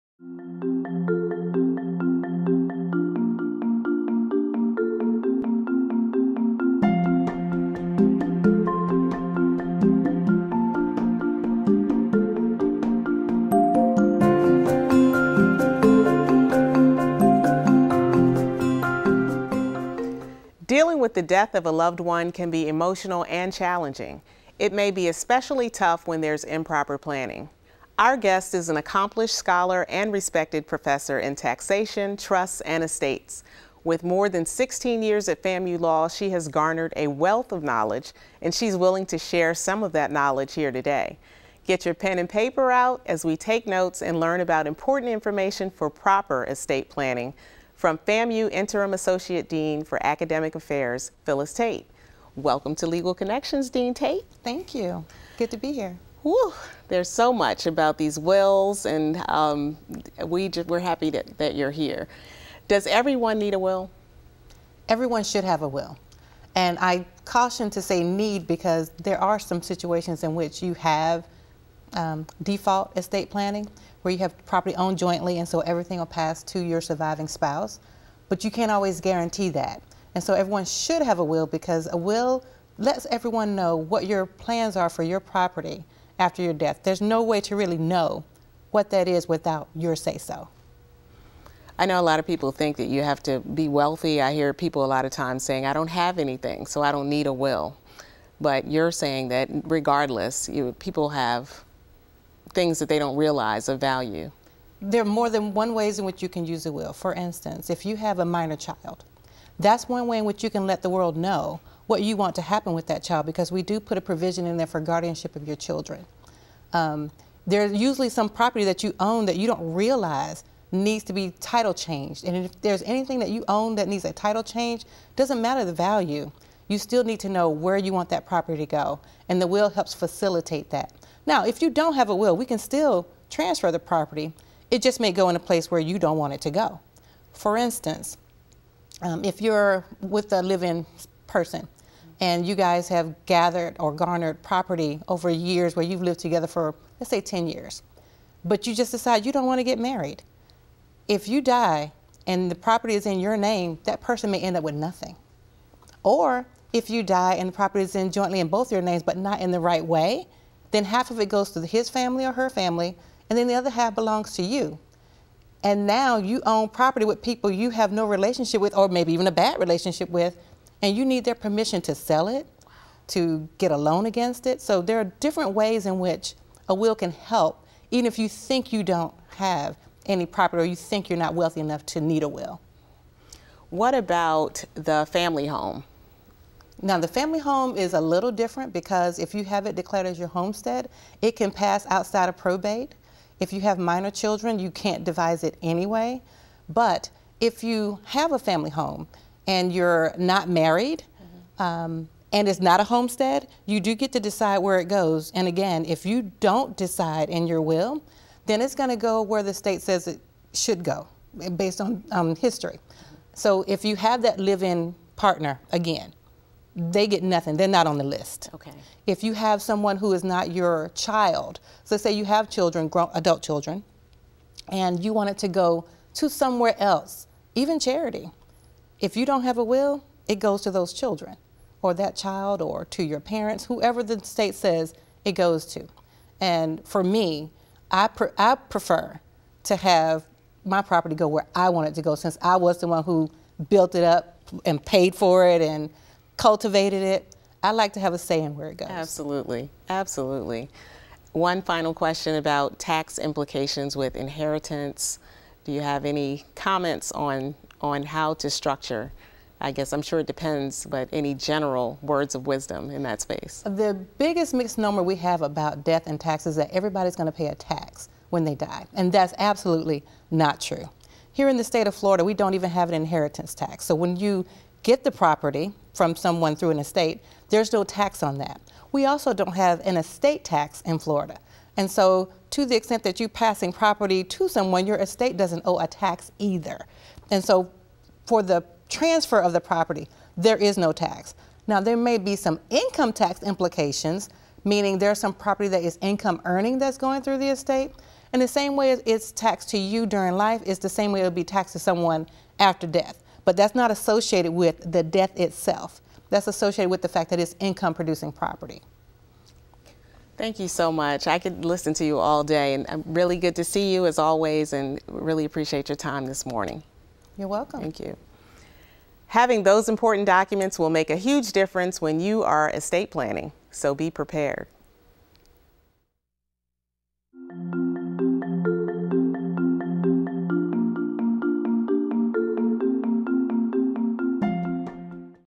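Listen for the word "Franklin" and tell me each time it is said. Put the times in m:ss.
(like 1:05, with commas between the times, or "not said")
not said.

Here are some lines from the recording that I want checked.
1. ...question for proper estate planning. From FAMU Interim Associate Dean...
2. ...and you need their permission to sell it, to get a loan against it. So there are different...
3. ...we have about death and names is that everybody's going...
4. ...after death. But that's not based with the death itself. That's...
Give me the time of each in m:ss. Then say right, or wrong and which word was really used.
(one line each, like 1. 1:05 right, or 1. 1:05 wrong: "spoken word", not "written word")
1. 0:45 wrong: "information", not "question"
2. 2:50 right
3. 4:25 wrong: "taxes", not "names"
4. 5:02 wrong: "associated", not "based".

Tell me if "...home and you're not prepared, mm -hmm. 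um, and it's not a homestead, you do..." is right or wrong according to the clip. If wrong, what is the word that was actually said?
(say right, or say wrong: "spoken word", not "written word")
wrong: "married", not "prepared".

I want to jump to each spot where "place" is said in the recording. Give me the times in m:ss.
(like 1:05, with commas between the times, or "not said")
2:15.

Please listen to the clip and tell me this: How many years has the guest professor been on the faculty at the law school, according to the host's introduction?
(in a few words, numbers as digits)
16.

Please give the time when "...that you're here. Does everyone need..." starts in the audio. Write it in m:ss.
1:01.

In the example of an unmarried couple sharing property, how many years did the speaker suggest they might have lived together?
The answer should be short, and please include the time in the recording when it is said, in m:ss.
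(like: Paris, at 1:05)
10 years, at 2:27.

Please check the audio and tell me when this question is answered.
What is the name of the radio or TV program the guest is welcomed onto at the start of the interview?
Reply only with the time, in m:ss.
0:52.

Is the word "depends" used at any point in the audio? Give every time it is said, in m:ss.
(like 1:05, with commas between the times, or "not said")
4:20.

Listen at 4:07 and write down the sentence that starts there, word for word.
I like to have a say in where it goes.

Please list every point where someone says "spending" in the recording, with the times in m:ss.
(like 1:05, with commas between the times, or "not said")
not said.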